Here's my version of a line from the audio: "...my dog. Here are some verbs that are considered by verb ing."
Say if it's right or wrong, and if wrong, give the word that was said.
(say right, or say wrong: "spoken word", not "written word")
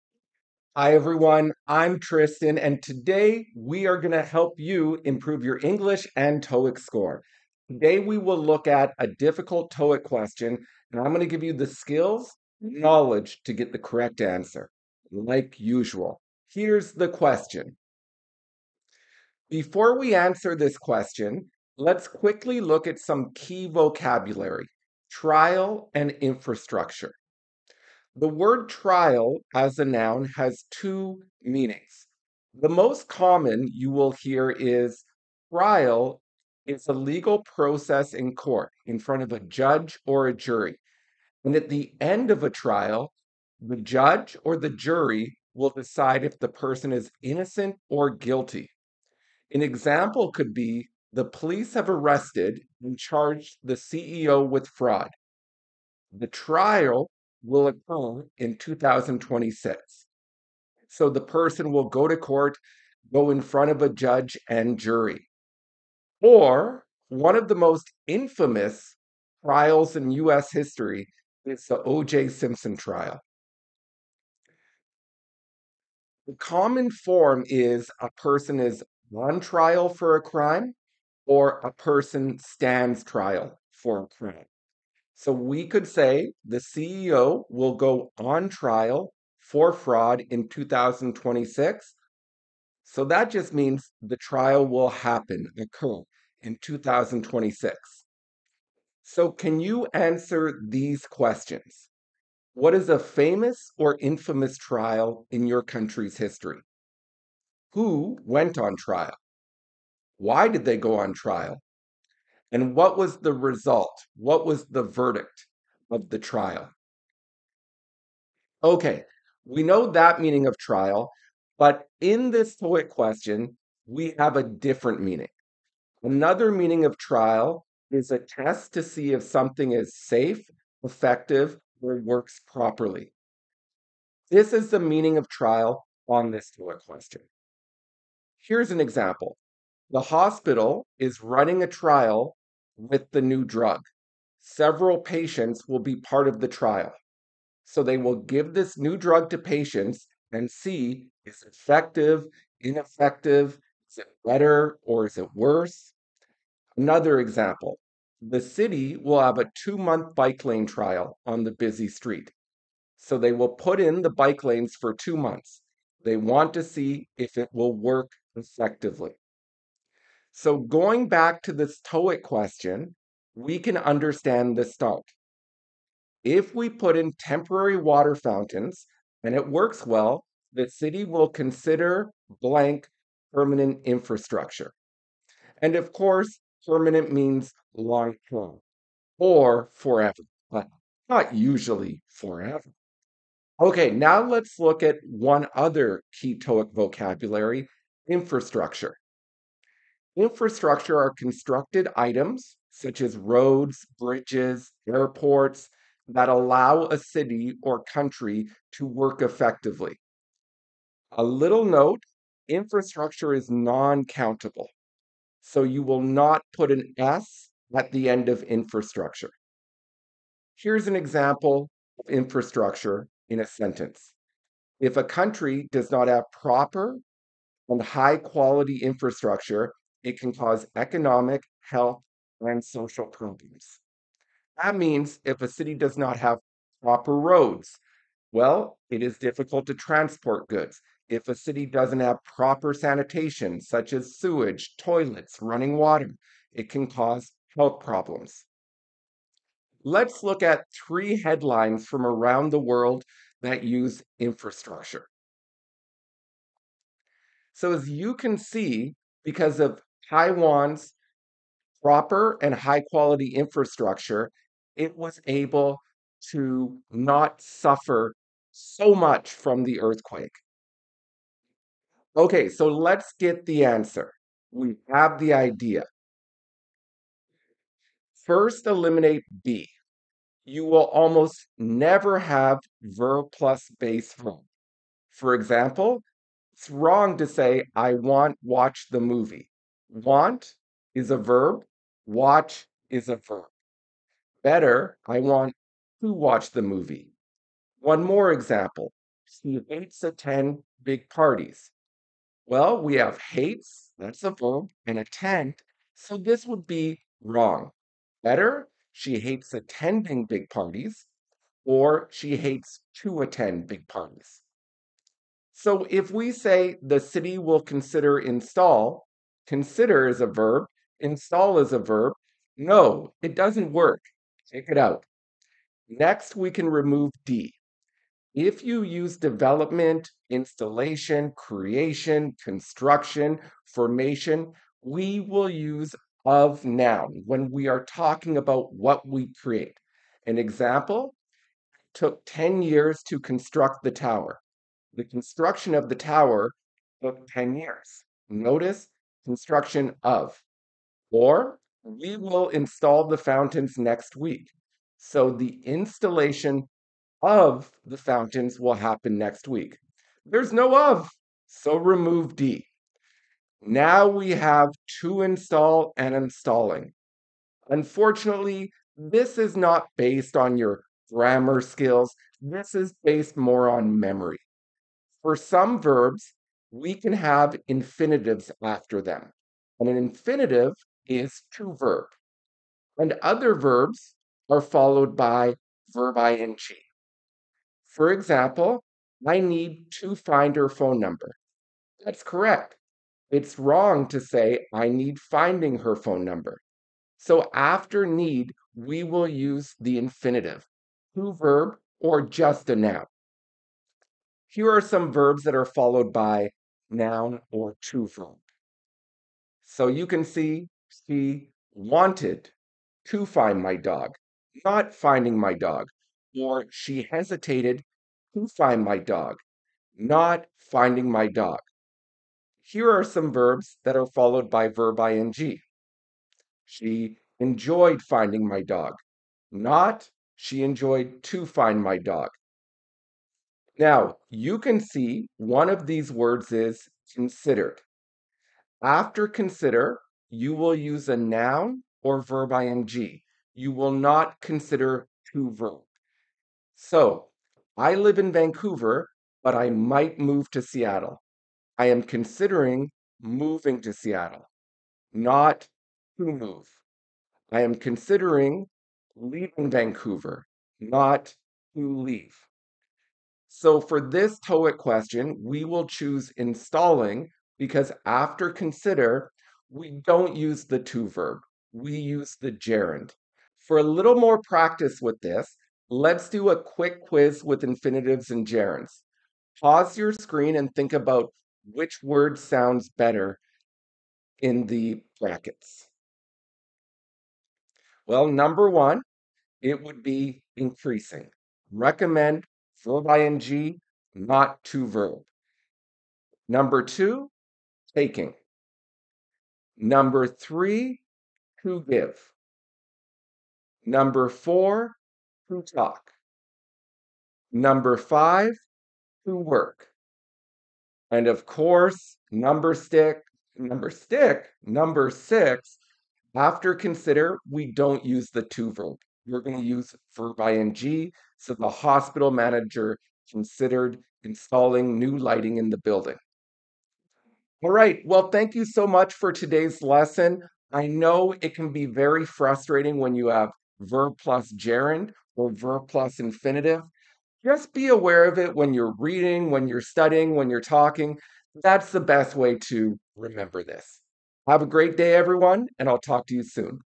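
wrong: "followed", not "considered".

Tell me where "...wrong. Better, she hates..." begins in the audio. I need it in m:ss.
5:07.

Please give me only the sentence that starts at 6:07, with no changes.
Unfortunately, this is not based on your grammar skills.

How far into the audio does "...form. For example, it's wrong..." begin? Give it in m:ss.
4:44.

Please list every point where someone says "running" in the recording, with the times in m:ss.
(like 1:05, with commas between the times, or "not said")
2:21, 4:05.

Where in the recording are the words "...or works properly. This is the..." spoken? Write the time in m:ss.
2:11.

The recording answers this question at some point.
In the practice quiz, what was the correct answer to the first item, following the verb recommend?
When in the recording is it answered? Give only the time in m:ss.
8:10.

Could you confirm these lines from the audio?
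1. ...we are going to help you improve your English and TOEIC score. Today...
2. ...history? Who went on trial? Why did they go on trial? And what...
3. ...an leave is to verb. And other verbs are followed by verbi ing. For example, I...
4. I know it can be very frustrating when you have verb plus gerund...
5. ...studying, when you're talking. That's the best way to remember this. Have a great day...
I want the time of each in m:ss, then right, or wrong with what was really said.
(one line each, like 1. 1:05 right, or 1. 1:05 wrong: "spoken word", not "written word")
1. 0:03 right
2. 1:46 right
3. 6:19 wrong: "infinitive", not "leave"
4. 8:50 right
5. 8:59 right.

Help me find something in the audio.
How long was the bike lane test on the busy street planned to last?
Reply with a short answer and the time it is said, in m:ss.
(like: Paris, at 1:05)
two months, at 2:39.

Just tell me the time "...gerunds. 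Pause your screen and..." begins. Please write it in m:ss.
7:58.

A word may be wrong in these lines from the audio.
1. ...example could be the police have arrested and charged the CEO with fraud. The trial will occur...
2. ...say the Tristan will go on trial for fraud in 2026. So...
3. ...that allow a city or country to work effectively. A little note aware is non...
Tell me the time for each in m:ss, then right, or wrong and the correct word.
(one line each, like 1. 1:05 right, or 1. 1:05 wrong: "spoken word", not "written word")
1. 0:49 right
2. 1:25 wrong: "CEO", not "Tristan"
3. 3:26 wrong: "infrastructure", not "aware".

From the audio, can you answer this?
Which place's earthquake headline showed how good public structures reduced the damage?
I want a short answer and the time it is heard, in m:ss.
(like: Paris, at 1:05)
Taiwan, at 4:20.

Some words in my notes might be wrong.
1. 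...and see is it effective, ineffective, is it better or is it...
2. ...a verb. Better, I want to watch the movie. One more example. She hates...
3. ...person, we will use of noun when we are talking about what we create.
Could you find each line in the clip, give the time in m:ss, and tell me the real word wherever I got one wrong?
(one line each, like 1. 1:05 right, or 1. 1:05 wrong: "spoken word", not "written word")
1. 2:30 right
2. 4:53 right
3. 5:33 wrong: "formation", not "person".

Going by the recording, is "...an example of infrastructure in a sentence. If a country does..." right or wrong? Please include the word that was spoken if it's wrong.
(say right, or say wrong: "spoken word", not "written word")
right.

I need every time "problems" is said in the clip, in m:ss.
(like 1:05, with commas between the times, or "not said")
3:53, 4:07.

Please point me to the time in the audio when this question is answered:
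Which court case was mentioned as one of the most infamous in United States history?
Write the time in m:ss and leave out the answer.
1:11.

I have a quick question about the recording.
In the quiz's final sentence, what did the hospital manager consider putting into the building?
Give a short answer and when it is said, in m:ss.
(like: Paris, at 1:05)
new lighting, at 8:44.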